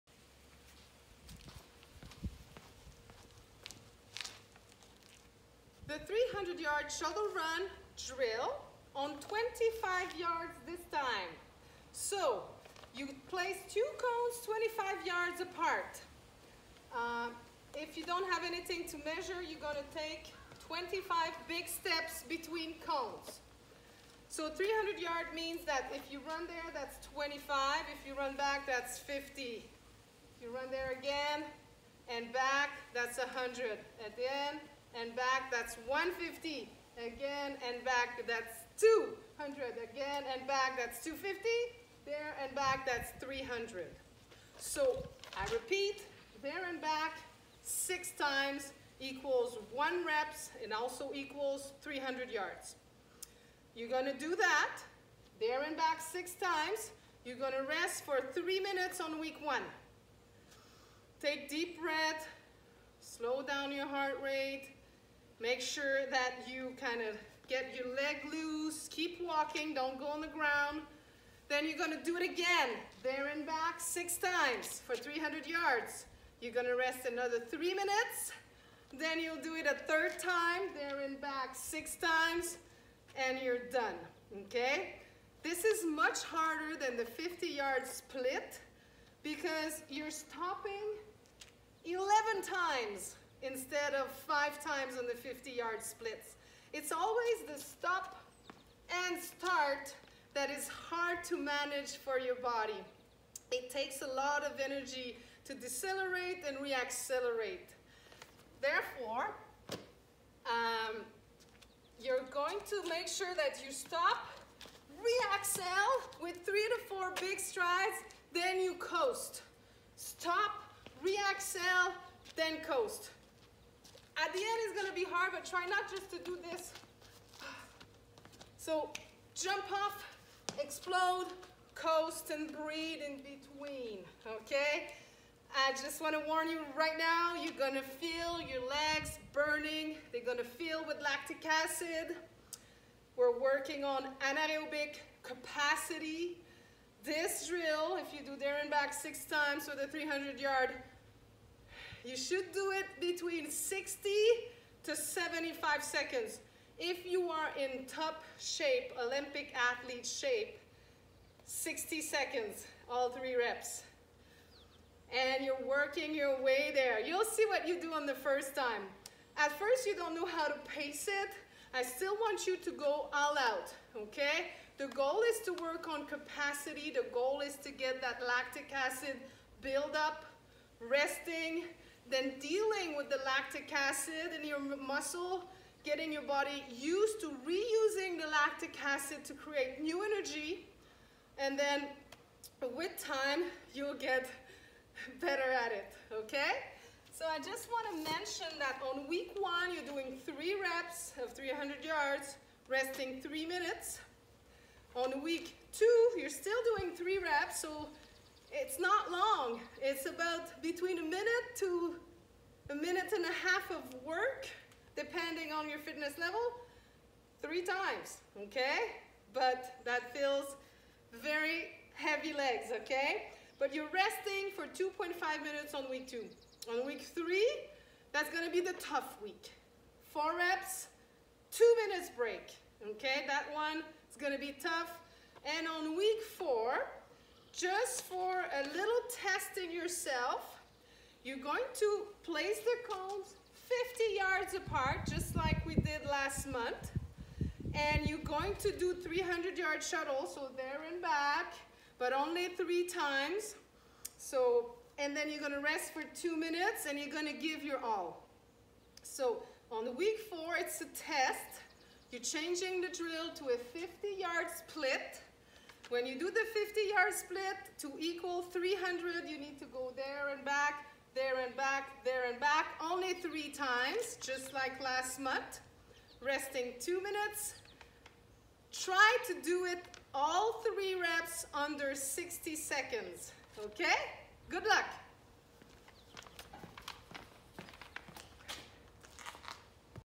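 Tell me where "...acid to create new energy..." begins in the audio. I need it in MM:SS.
03:08.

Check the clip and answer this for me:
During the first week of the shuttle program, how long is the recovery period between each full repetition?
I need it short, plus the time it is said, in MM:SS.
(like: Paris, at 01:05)
3 minutes, at 00:58.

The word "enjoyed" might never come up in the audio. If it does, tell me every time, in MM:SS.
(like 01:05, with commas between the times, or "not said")
not said.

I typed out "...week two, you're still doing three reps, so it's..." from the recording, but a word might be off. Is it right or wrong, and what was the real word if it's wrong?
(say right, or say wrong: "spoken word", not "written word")
right.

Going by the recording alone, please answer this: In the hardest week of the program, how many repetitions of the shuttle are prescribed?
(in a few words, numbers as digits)
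4.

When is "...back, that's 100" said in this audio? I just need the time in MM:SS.
00:32.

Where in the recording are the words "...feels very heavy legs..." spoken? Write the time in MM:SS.
03:40.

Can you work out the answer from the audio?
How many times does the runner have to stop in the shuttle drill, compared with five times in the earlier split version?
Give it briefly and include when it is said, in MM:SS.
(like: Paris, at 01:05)
11, at 01:31.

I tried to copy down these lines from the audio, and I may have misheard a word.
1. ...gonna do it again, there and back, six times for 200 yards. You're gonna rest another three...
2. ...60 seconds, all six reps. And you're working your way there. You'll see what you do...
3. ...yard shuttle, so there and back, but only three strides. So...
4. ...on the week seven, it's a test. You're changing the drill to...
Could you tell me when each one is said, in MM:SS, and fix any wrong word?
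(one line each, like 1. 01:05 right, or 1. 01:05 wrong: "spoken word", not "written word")
1. 01:11 wrong: "300", not "200"
2. 02:41 wrong: "three", not "six"
3. 04:09 wrong: "times", not "strides"
4. 04:19 wrong: "four", not "seven".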